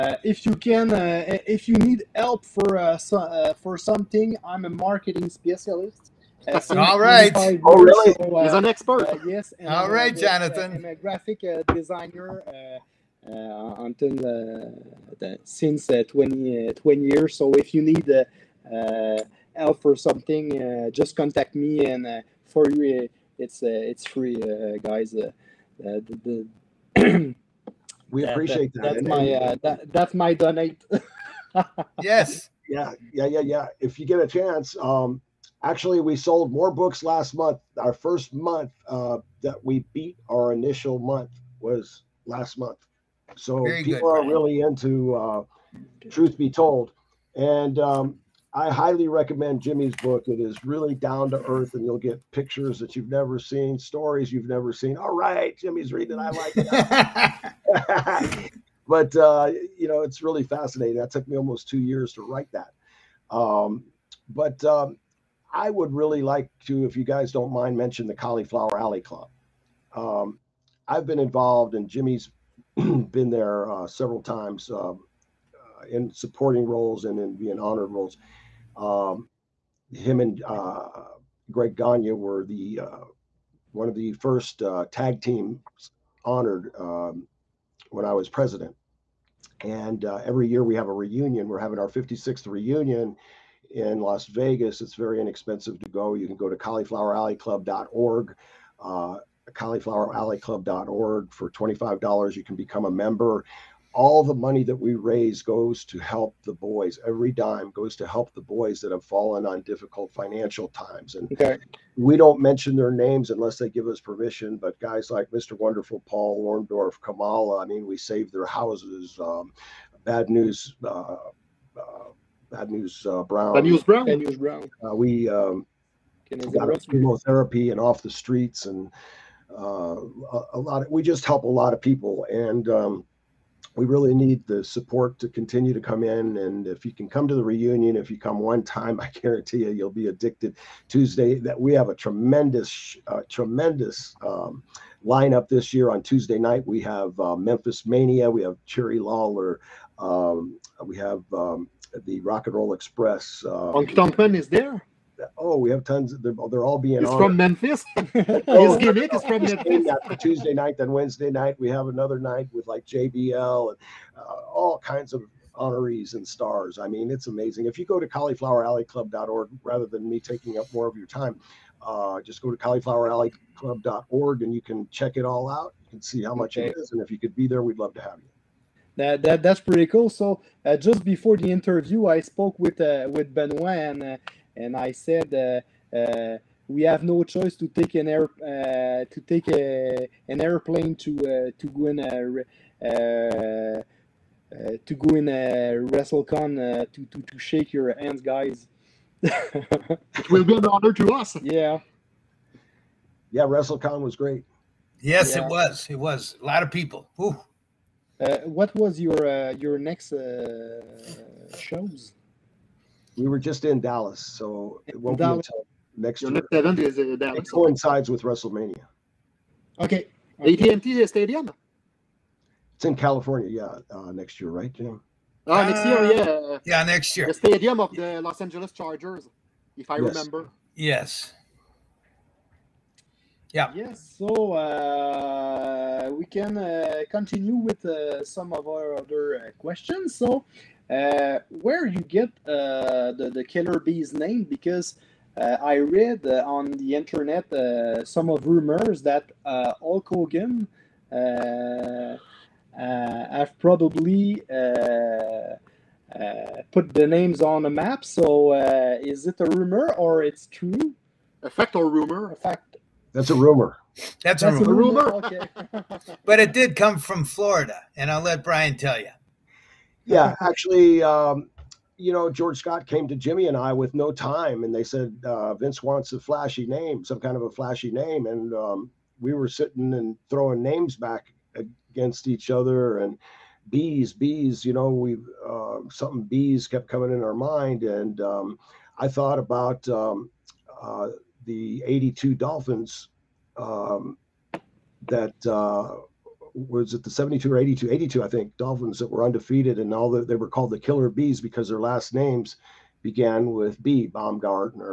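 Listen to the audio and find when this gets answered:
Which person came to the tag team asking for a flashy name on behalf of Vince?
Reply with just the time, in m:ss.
4:32.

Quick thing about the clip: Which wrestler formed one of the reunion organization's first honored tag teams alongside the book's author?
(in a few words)
Greg Gagne.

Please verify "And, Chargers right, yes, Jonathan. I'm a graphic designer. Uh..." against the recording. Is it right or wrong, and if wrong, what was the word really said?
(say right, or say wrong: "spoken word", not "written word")
wrong: "All", not "Chargers".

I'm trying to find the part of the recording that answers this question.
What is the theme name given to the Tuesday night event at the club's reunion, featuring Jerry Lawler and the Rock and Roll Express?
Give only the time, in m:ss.
2:27.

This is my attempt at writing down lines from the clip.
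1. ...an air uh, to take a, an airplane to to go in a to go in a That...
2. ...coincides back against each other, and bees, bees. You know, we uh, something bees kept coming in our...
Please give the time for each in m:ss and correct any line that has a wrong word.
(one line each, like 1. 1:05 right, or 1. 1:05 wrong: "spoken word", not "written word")
1. 3:07 wrong: "WrestleCon", not "That"
2. 4:40 wrong: "names", not "coincides".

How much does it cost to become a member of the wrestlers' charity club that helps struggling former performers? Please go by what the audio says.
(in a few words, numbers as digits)
$25.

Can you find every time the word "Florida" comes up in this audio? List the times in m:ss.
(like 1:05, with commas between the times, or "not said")
4:27.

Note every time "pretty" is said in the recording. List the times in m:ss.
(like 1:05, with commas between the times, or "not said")
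2:59.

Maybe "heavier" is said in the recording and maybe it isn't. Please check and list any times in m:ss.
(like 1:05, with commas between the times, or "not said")
not said.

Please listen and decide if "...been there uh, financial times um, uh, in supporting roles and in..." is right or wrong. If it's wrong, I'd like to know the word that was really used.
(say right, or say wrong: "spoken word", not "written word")
wrong: "several", not "financial".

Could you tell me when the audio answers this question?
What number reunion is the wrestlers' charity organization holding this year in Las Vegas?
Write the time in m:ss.
1:31.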